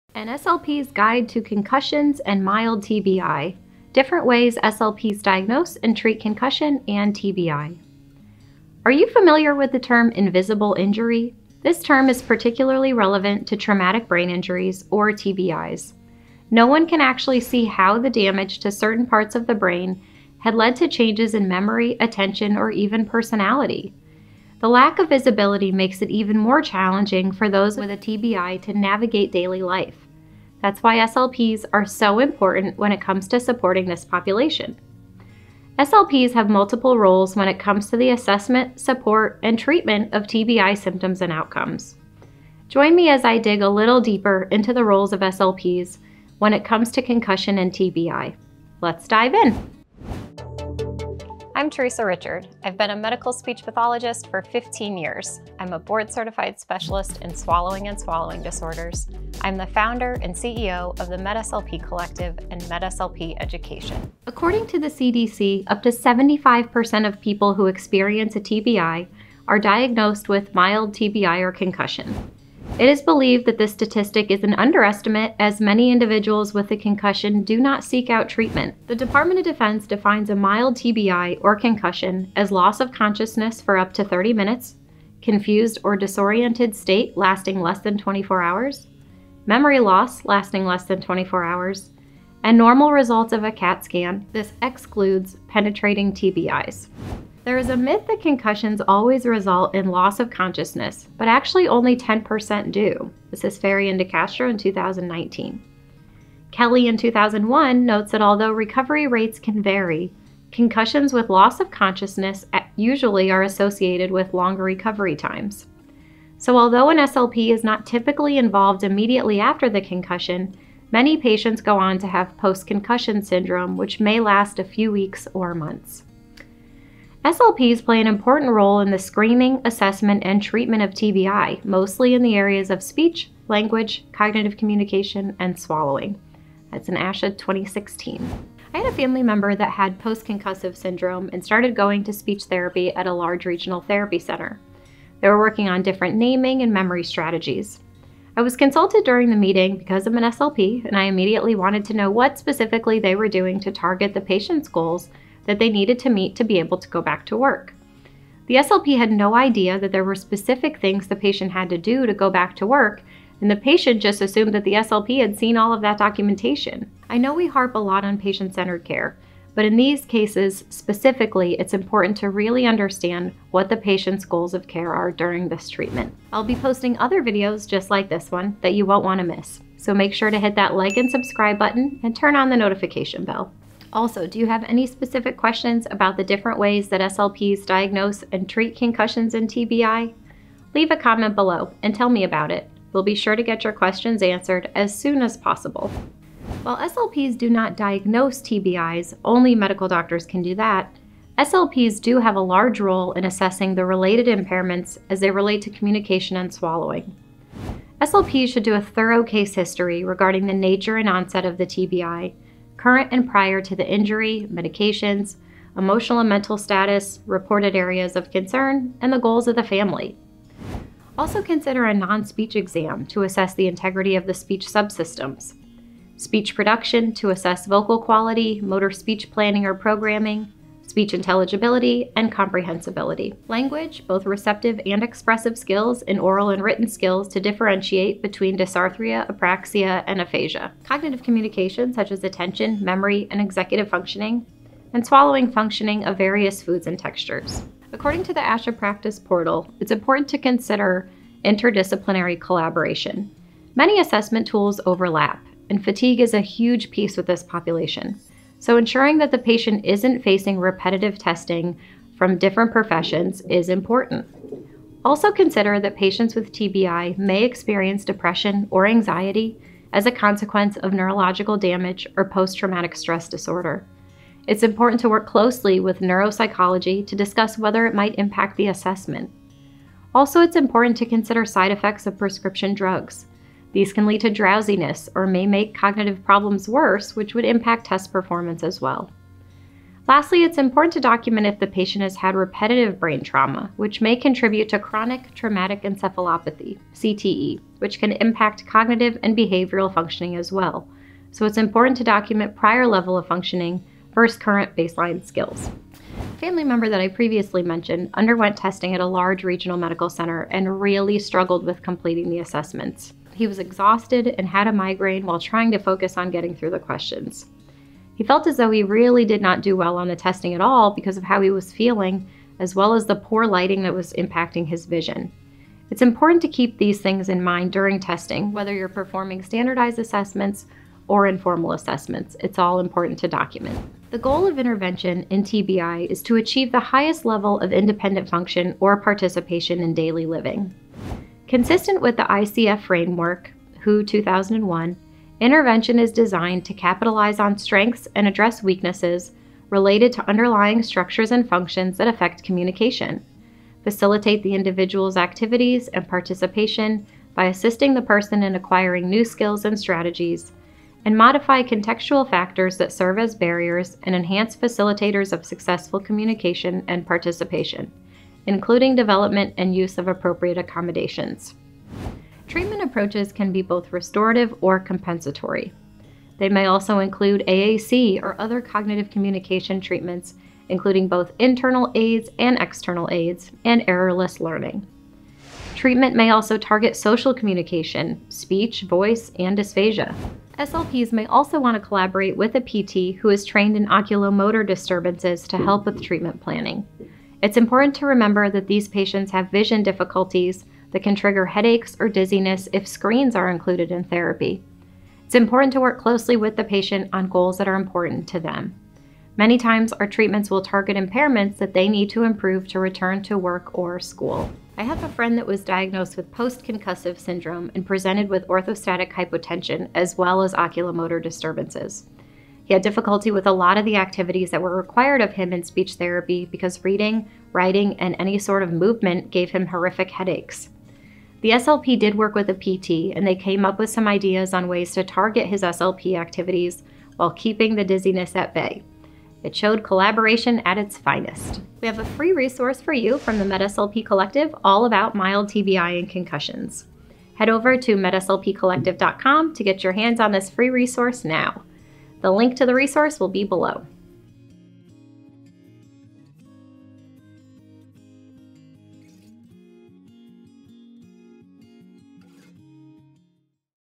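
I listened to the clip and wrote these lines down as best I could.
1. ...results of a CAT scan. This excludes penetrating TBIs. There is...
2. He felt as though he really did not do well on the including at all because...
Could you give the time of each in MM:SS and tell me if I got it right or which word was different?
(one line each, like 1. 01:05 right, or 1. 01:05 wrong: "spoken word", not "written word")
1. 01:32 right
2. 05:18 wrong: "testing", not "including".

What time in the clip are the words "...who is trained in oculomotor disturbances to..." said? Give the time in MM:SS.
06:33.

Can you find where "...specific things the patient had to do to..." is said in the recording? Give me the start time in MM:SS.
02:40.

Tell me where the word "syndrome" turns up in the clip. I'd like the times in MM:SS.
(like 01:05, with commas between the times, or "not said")
02:03, 02:20, 06:57.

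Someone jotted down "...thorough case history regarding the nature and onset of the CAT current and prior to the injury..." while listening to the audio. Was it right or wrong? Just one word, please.
wrong.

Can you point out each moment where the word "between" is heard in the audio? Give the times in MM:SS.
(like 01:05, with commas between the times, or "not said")
03:58.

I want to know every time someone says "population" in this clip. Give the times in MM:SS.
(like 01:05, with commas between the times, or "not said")
00:34, 04:17.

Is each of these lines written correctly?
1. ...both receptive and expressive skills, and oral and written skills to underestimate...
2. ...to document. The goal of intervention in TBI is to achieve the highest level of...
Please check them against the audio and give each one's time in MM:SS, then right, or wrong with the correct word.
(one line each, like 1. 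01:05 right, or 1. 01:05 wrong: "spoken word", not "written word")
1. 03:54 wrong: "differentiate", not "underestimate"
2. 05:33 right.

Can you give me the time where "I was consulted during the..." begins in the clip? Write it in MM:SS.
02:28.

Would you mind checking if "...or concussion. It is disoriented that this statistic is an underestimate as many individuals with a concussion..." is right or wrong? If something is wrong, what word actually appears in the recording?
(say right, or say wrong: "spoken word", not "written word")
wrong: "believed", not "disoriented".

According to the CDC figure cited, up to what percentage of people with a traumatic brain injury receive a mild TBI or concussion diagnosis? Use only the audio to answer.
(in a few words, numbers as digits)
75%.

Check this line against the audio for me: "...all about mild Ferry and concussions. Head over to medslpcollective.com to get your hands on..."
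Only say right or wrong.
wrong.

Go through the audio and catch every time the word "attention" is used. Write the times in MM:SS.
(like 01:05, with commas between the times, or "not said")
00:21, 04:02.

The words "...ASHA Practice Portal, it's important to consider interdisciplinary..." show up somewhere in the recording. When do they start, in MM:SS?
04:08.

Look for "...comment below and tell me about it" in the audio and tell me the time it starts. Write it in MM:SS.
03:10.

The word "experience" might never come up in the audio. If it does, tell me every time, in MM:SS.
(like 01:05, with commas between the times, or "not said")
01:07, 04:27.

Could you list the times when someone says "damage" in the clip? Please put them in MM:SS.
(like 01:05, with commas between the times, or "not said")
00:18, 04:31.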